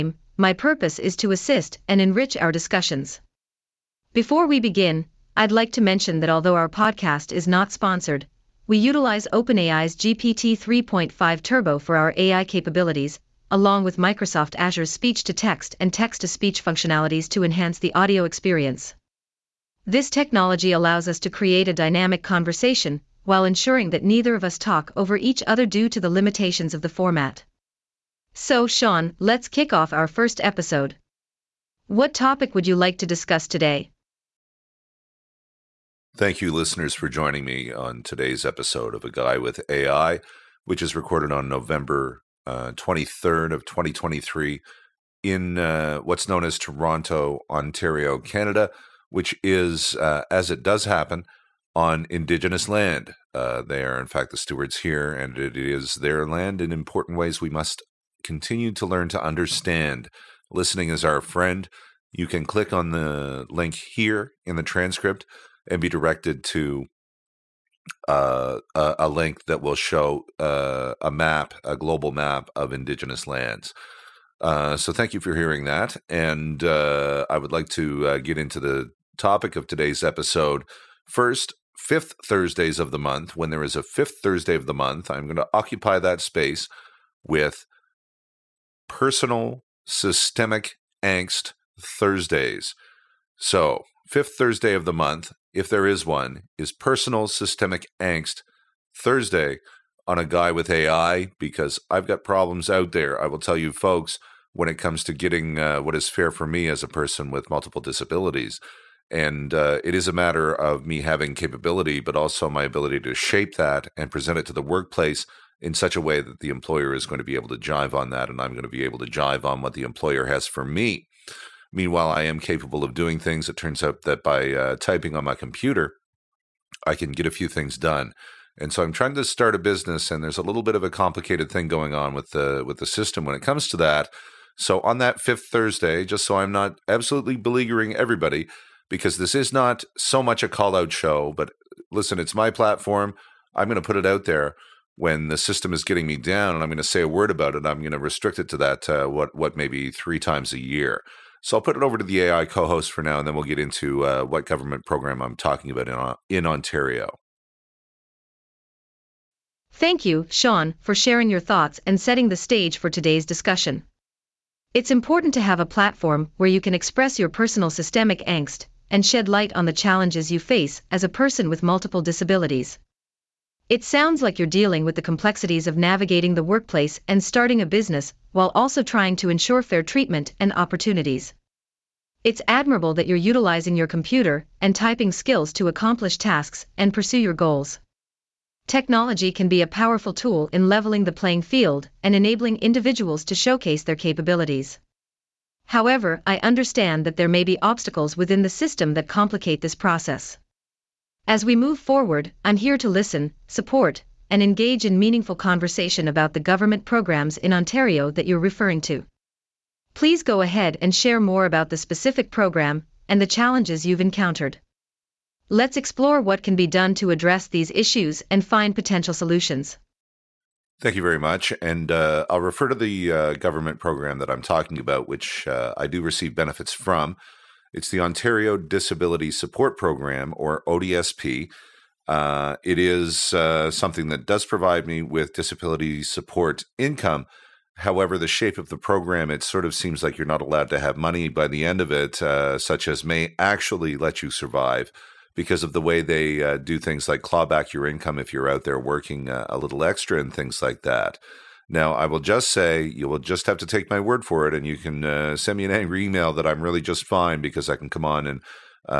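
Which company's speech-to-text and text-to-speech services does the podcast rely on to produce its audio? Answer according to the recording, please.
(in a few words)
Microsoft Azure.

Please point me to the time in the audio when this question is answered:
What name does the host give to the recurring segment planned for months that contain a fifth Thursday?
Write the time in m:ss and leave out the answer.
1:36.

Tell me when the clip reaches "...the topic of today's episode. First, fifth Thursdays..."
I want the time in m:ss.
1:18.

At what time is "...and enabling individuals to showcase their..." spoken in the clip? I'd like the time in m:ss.
3:12.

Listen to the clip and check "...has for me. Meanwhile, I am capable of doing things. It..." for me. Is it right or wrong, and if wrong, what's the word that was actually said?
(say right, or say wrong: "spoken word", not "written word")
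right.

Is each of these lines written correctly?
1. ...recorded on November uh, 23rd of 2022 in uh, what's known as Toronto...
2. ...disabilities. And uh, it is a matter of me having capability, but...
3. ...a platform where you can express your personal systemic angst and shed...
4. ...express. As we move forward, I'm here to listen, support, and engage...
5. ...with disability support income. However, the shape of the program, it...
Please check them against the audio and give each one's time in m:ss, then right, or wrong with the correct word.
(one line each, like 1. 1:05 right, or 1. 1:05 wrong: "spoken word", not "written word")
1. 0:40 wrong: "2023", not "2022"
2. 1:47 right
3. 2:45 right
4. 3:19 wrong: "process", not "express"
5. 3:55 right.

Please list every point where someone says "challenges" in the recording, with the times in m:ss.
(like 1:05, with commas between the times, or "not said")
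2:49, 3:33.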